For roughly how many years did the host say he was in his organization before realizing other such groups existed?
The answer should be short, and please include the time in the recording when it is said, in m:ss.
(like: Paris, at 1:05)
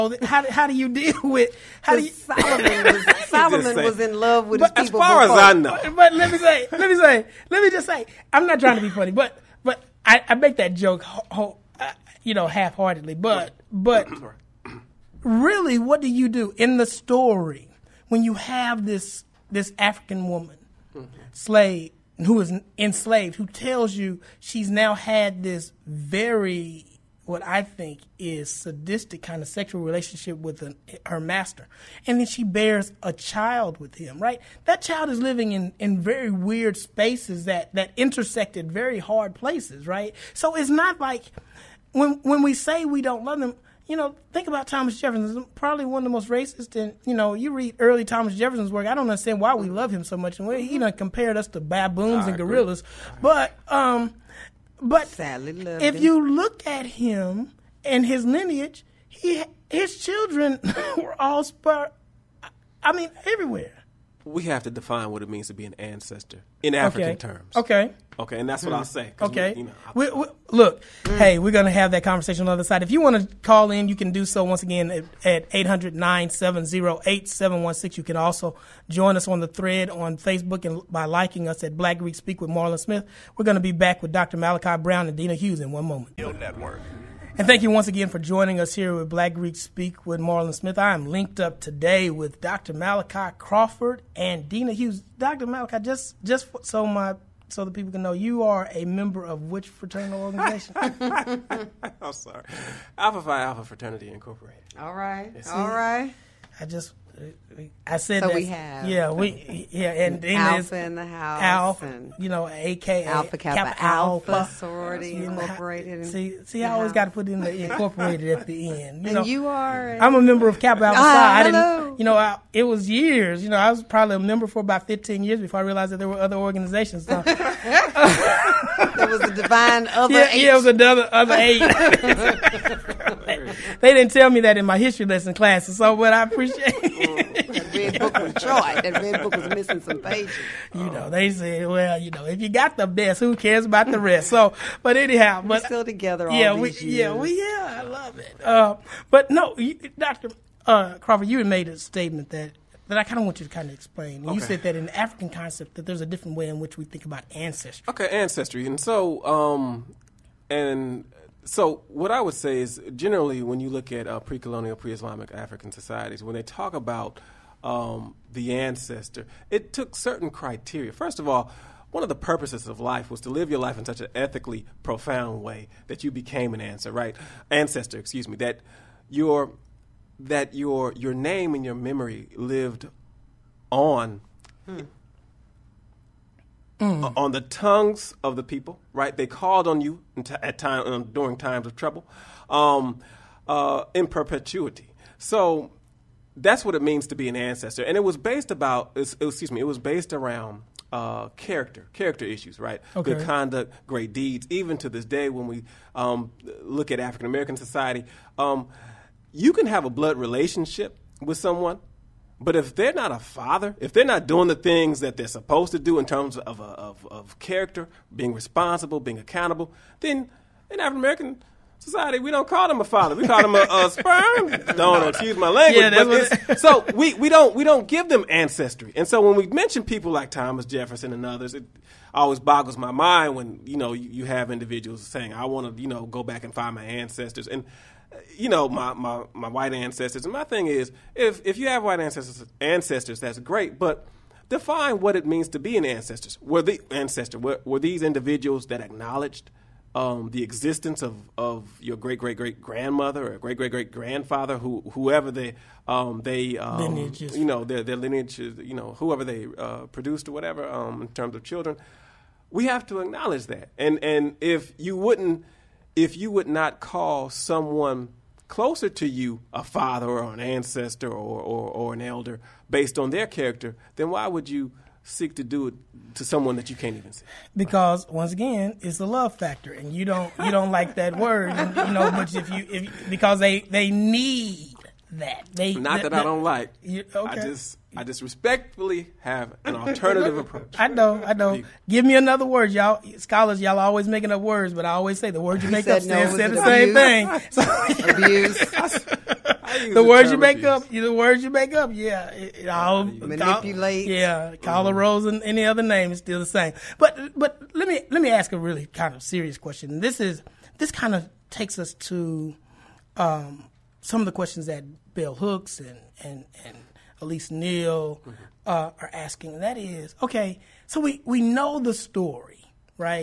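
15, at 2:04.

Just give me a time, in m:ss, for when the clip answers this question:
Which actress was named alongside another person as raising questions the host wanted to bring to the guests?
5:17.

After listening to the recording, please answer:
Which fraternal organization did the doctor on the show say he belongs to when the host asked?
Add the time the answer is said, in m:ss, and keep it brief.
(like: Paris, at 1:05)
Alpha Phi Alpha, at 1:42.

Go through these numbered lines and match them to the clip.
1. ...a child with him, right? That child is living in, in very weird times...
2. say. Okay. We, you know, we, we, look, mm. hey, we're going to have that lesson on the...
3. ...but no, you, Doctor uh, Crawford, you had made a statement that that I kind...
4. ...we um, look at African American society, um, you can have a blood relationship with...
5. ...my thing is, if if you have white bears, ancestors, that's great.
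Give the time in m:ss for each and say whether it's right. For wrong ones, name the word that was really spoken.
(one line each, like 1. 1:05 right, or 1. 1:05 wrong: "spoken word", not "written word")
1. 0:33 wrong: "spaces", not "times"
2. 1:08 wrong: "conversation", not "lesson"
3. 2:29 right
4. 3:25 right
5. 4:00 wrong: "ancestors", not "bears".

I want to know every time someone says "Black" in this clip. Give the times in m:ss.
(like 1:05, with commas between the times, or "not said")
1:21, 1:29.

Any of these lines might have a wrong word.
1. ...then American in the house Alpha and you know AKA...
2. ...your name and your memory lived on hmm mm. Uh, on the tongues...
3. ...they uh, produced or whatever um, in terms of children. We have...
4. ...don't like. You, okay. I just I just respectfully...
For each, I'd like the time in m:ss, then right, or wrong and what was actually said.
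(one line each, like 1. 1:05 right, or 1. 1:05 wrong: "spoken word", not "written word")
1. 1:50 wrong: "Alpha", not "American"
2. 3:00 right
3. 4:19 right
4. 4:46 right.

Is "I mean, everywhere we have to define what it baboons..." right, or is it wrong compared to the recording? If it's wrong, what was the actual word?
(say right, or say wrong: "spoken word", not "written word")
wrong: "means", not "baboons".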